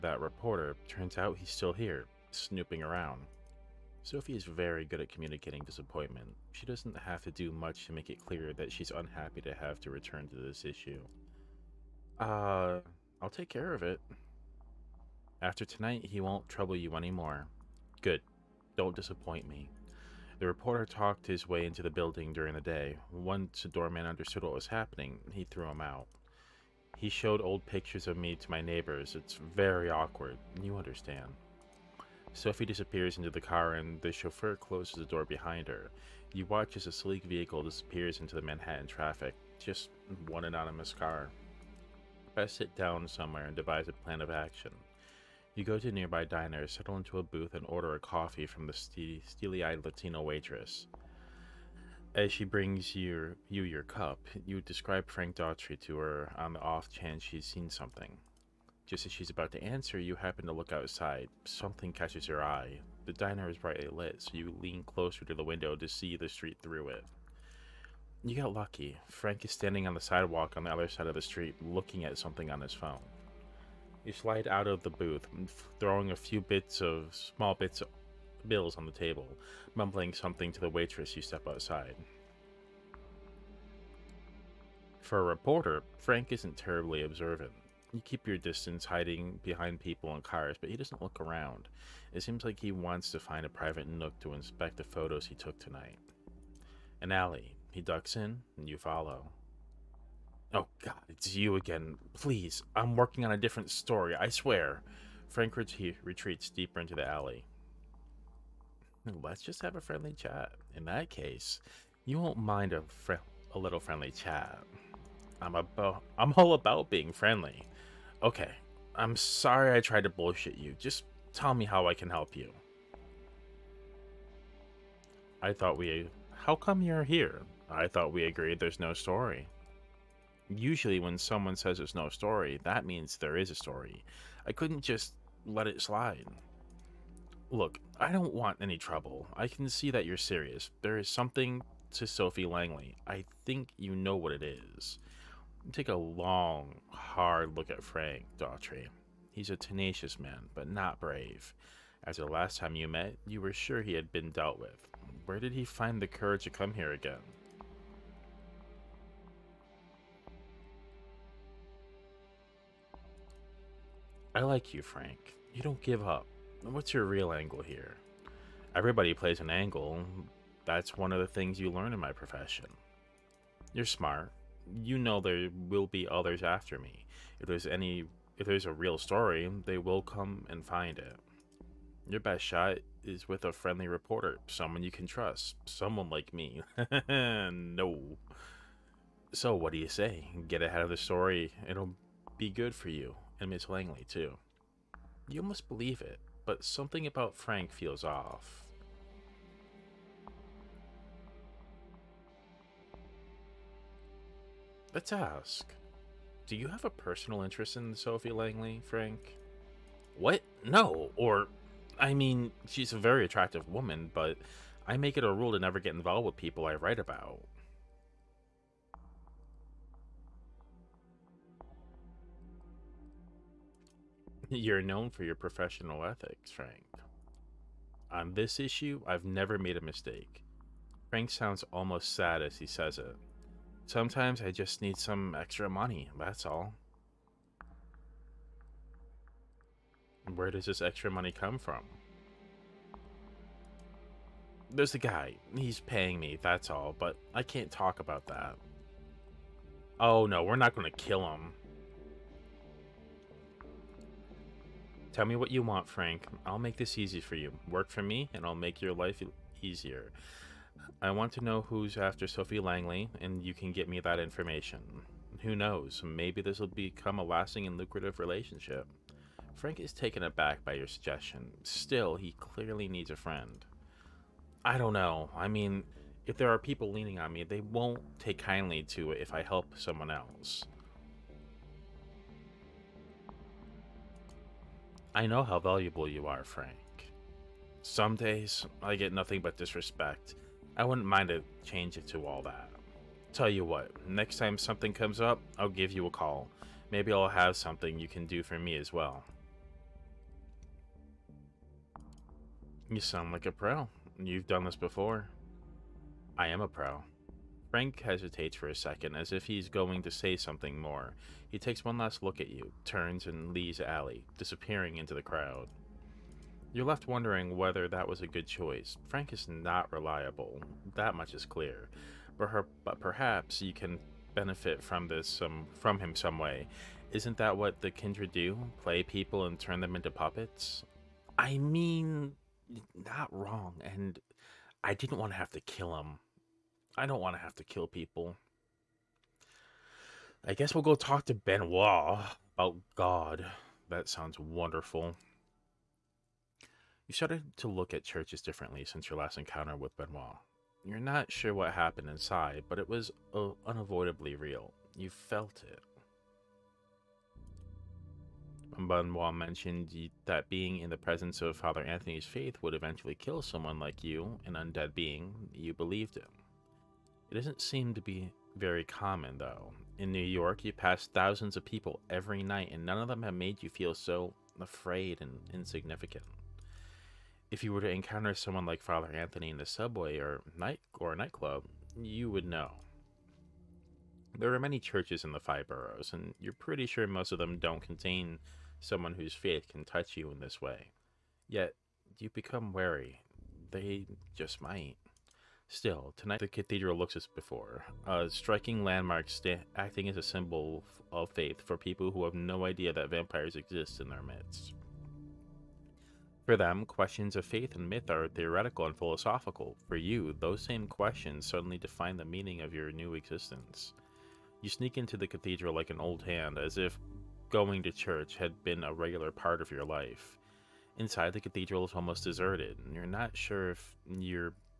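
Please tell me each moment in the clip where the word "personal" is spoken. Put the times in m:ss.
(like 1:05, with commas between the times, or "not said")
3:26.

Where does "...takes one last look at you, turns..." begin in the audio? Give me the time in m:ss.
5:11.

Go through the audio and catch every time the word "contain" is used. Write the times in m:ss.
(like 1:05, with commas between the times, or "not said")
6:27.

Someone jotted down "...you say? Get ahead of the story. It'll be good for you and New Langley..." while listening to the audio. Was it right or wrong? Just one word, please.
wrong.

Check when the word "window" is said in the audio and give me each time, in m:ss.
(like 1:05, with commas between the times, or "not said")
1:05.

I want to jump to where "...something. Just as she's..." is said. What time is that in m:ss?
0:57.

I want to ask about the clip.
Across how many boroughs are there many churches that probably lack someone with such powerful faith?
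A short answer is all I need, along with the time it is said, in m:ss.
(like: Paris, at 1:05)
5, at 6:25.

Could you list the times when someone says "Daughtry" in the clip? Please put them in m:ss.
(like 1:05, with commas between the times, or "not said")
0:55, 2:28.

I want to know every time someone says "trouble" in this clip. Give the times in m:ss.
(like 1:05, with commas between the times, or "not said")
0:16, 2:18.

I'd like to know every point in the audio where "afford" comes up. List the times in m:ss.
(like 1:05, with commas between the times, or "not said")
not said.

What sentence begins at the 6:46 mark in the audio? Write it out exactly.
For them, questions of faith and myth are theoretical and philosophical.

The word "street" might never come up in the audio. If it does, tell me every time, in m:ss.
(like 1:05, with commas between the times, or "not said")
1:06, 1:11.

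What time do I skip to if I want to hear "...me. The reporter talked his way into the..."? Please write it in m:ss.
0:19.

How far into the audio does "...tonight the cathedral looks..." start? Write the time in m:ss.
6:36.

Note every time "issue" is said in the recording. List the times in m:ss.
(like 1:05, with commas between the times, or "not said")
0:10, 3:48.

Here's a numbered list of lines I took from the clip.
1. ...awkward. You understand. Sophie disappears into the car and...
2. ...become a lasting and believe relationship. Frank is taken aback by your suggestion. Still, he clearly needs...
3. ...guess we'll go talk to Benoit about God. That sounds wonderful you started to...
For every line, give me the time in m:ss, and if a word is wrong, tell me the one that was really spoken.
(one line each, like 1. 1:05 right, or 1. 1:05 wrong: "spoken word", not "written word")
1. 0:29 right
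2. 4:26 wrong: "lucrative", not "believe"
3. 5:40 right.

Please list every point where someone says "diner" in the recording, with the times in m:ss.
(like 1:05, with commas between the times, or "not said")
0:46, 1:03.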